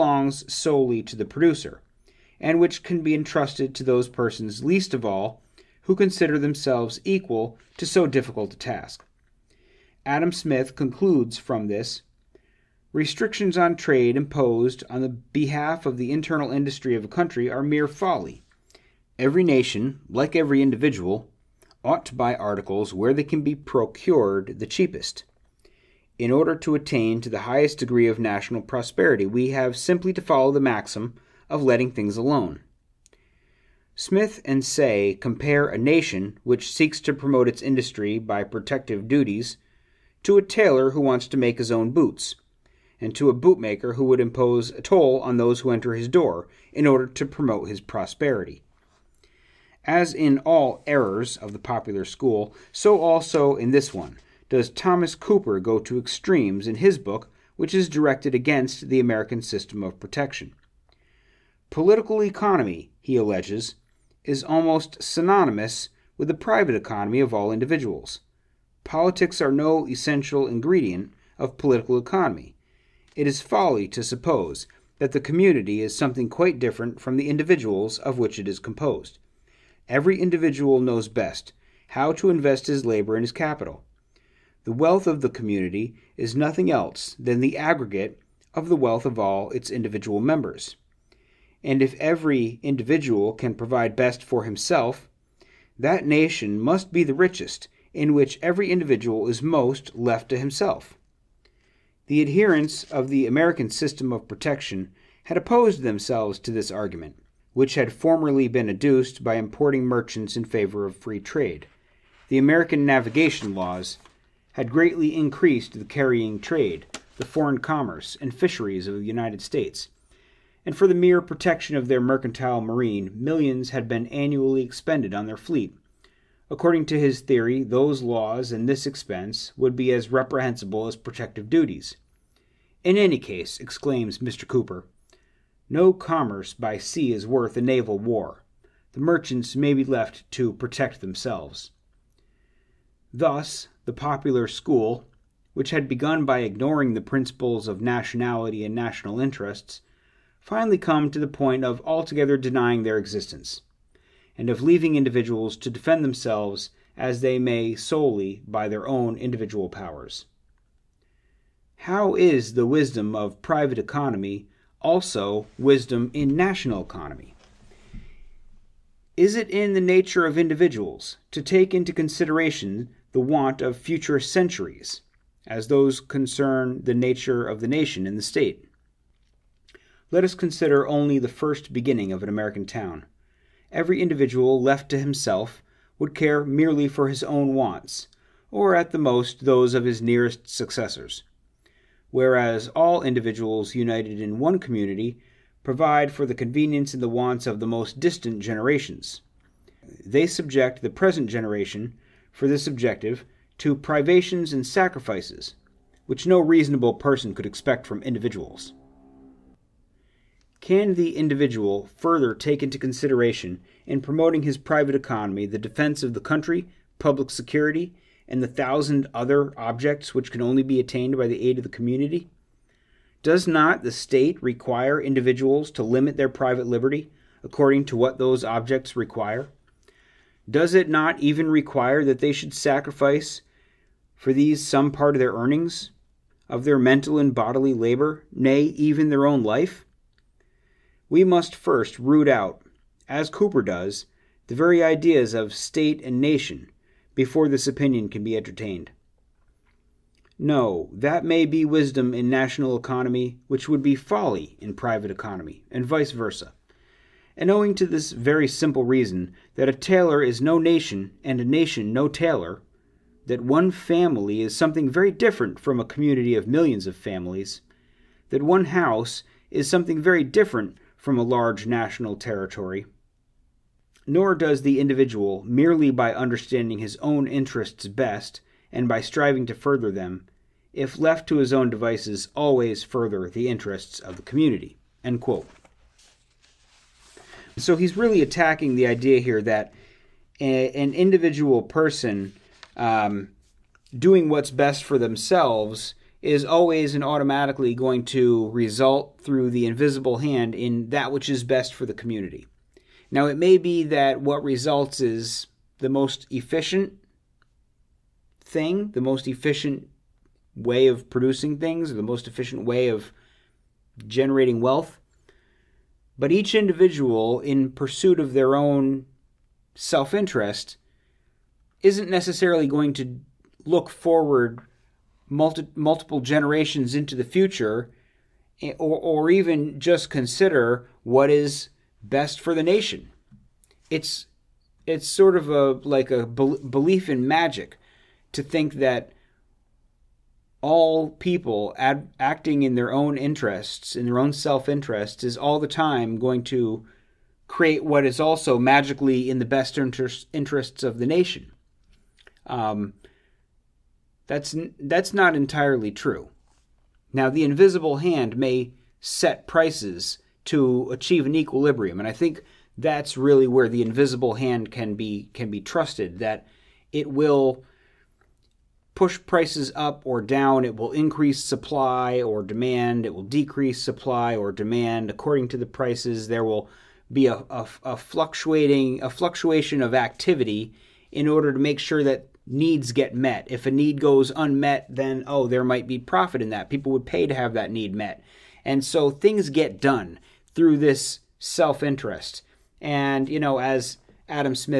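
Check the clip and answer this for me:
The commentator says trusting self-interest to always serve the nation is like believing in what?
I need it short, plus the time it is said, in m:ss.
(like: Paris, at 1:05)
magic, at 5:37.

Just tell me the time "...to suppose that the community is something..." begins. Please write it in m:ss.
1:13.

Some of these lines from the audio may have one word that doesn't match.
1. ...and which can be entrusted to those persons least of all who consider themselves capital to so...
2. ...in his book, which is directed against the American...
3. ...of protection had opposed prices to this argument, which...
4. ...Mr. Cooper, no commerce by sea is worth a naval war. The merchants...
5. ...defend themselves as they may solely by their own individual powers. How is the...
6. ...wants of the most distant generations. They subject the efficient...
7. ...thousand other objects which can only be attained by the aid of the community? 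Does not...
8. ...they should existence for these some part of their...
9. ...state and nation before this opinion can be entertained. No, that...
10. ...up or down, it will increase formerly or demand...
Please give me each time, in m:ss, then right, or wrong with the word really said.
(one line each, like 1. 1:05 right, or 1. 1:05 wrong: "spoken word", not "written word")
1. 0:02 wrong: "equal", not "capital"
2. 0:56 right
3. 1:44 wrong: "themselves", not "prices"
4. 2:14 right
5. 2:35 right
6. 3:17 wrong: "present", not "efficient"
7. 3:38 right
8. 3:52 wrong: "sacrifice", not "existence"
9. 4:05 right
10. 6:09 wrong: "supply", not "formerly".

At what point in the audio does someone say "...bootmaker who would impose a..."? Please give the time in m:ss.
0:43.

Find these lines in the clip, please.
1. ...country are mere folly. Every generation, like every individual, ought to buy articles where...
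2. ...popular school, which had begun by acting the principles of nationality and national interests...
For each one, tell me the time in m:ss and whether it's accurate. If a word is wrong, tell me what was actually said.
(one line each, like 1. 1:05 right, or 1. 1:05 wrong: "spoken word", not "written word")
1. 0:17 wrong: "nation", not "generation"
2. 2:23 wrong: "ignoring", not "acting".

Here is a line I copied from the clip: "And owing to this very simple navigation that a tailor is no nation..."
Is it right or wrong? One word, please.
wrong.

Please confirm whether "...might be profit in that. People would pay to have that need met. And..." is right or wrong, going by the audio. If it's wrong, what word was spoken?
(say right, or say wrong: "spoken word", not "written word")
right.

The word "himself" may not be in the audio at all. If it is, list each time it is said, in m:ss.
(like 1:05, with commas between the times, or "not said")
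1:34, 1:40, 3:04.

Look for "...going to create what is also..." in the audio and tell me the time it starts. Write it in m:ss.
5:46.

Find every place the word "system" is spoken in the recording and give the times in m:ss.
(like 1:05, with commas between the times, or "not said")
0:59, 1:43.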